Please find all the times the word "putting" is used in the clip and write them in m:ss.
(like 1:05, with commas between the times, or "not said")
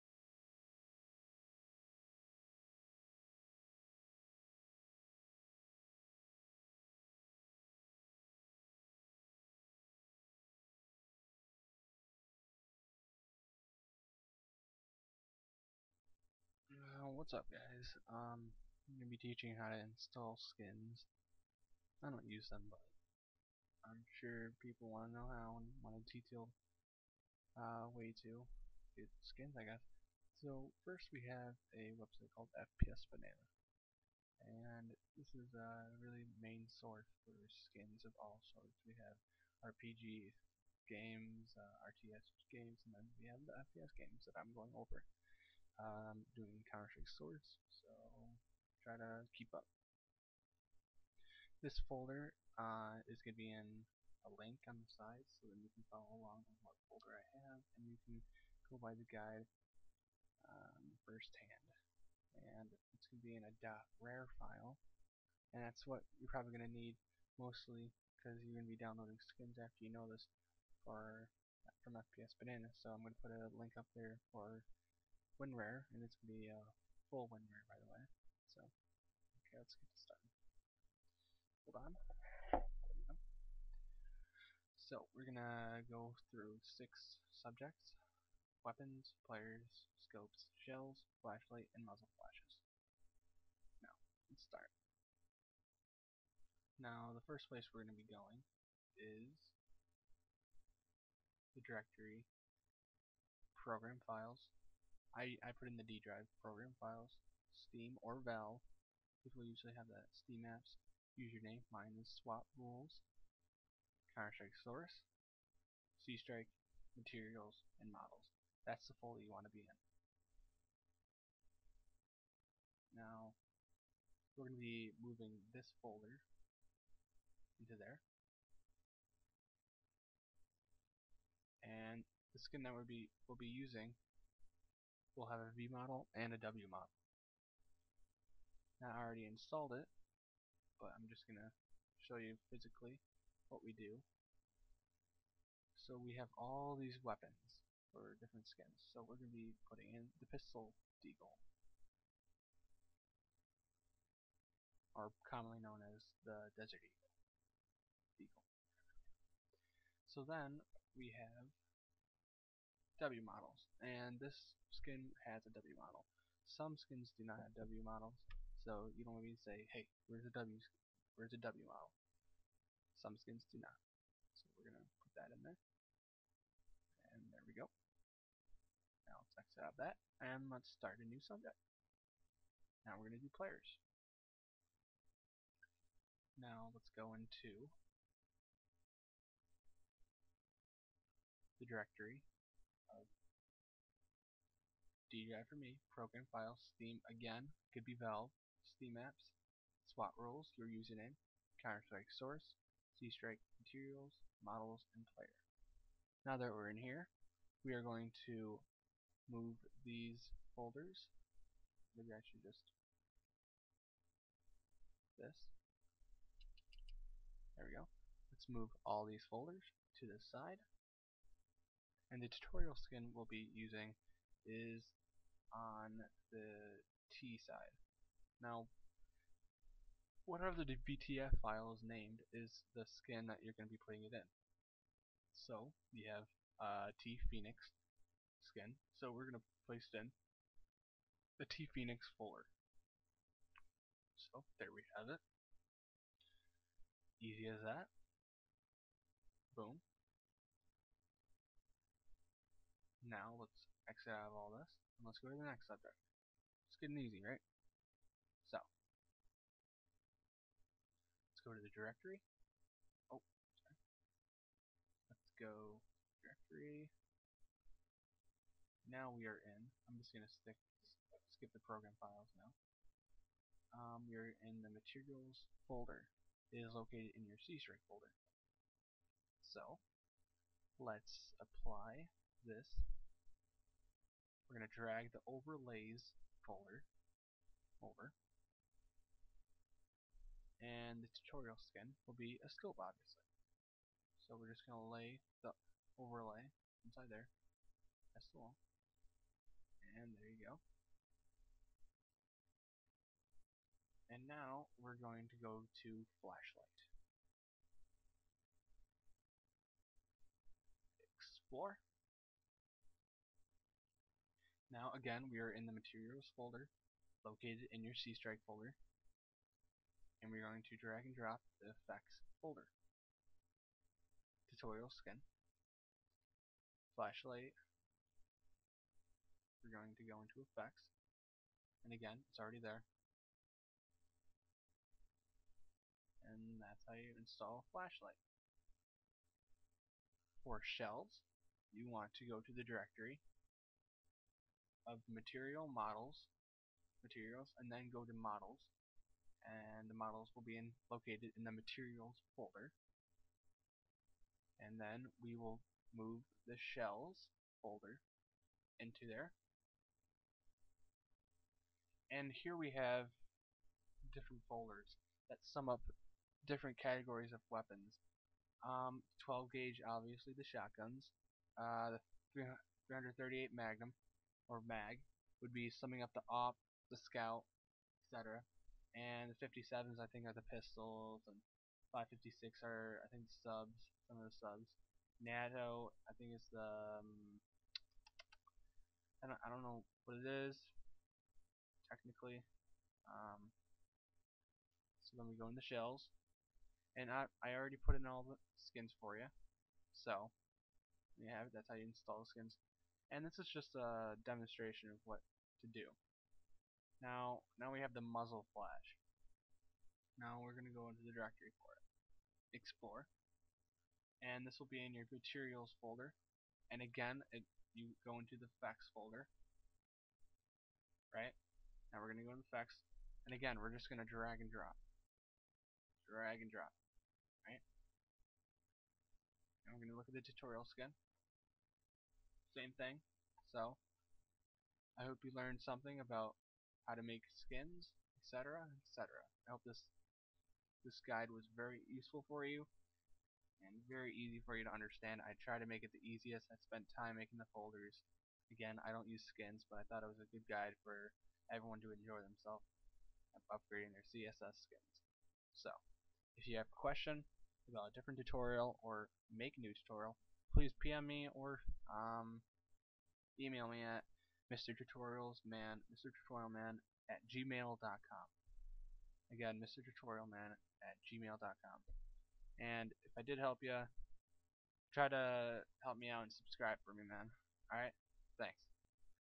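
2:29, 3:53.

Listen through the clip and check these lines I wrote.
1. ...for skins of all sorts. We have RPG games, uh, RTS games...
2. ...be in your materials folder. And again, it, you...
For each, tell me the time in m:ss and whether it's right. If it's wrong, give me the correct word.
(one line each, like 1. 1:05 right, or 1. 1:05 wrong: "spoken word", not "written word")
1. 0:37 right
2. 6:54 right.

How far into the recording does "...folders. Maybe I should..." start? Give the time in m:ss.
3:30.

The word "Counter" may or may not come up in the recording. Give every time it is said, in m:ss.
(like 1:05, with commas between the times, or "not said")
0:46, 1:54, 3:21.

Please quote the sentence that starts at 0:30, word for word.
So first we have a website called FPS Banana.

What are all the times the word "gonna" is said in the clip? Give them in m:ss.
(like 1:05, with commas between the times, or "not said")
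2:54, 3:03.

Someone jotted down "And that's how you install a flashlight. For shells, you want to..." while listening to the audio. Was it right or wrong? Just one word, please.
right.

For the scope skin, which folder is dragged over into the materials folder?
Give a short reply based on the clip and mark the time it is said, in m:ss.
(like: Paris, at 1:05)
overlays, at 4:45.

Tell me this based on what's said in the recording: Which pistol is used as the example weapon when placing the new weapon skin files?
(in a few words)
Desert Eagle.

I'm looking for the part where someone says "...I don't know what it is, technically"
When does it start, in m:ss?
6:29.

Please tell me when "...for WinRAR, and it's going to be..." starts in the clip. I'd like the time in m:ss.
1:14.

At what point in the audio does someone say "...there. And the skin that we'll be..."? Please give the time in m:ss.
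2:07.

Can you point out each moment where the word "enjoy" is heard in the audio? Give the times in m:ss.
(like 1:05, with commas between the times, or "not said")
7:31.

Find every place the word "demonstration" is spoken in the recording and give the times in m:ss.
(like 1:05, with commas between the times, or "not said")
6:44.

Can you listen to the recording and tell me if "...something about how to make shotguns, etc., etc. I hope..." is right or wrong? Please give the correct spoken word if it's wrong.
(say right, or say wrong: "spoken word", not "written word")
wrong: "skins", not "shotguns".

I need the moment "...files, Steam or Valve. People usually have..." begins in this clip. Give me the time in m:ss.
1:46.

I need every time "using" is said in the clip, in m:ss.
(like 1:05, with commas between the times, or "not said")
2:13, 3:43.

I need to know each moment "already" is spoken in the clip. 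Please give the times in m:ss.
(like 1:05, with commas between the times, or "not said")
2:19, 5:32, 6:37.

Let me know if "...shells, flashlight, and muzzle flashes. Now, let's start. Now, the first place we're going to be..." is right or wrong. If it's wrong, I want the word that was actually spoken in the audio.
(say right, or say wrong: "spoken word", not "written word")
right.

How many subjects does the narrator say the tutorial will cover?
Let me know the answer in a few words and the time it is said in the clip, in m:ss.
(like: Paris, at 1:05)
6, at 1:26.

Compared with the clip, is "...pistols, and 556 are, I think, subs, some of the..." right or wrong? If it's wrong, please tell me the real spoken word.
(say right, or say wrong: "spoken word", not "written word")
right.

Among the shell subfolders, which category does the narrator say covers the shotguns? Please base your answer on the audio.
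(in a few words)
12 gauge.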